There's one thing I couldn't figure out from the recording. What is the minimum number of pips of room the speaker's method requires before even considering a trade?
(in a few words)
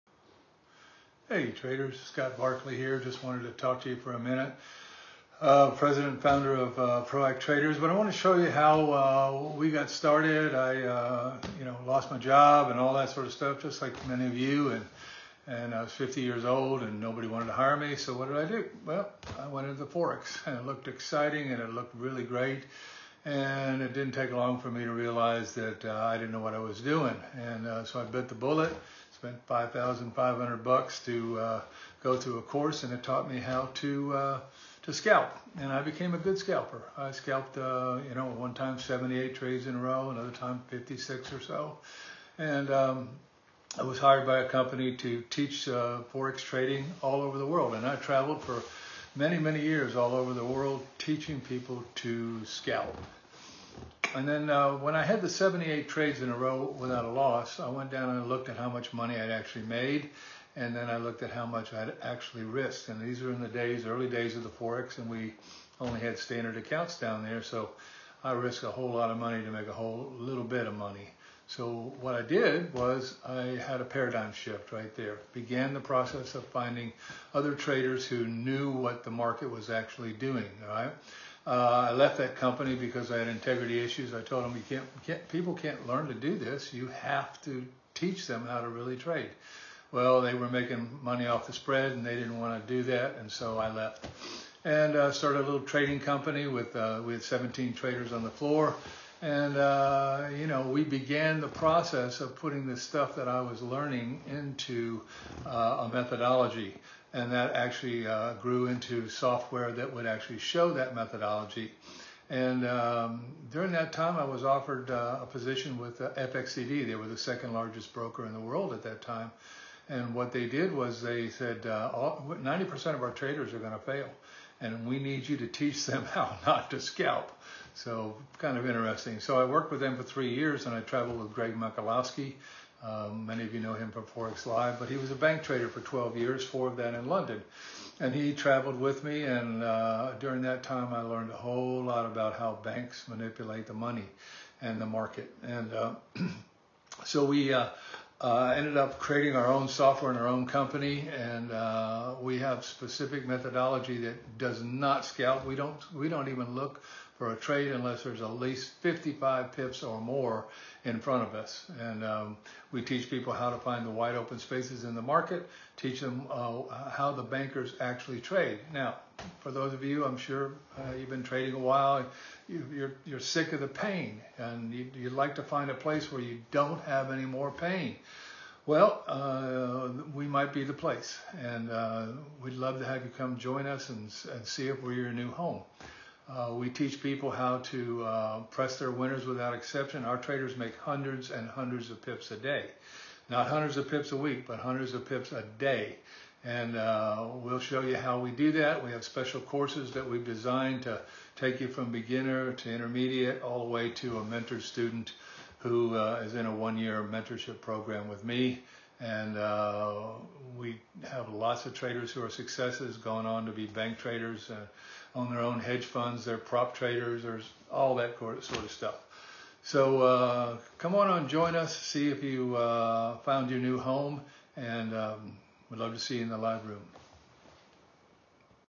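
55.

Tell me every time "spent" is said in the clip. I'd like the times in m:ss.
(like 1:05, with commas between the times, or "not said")
0:29.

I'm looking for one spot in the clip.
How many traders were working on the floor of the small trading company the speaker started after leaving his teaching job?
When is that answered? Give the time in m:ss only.
1:37.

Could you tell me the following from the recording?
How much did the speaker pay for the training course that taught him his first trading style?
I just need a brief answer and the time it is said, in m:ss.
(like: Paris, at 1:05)
$5,500, at 0:29.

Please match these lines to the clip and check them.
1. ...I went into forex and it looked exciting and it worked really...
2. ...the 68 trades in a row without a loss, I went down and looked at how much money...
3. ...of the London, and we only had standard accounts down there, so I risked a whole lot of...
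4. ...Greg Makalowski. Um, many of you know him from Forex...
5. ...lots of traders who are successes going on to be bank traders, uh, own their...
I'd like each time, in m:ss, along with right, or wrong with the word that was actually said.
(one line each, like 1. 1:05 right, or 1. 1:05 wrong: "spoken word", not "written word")
1. 0:19 wrong: "looked", not "worked"
2. 0:55 wrong: "78", not "68"
3. 1:04 wrong: "Forex", not "London"
4. 2:11 right
5. 3:31 right.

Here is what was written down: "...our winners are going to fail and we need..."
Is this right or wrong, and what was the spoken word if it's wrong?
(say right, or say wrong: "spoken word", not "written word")
wrong: "traders", not "winners".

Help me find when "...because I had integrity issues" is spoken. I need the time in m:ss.
1:22.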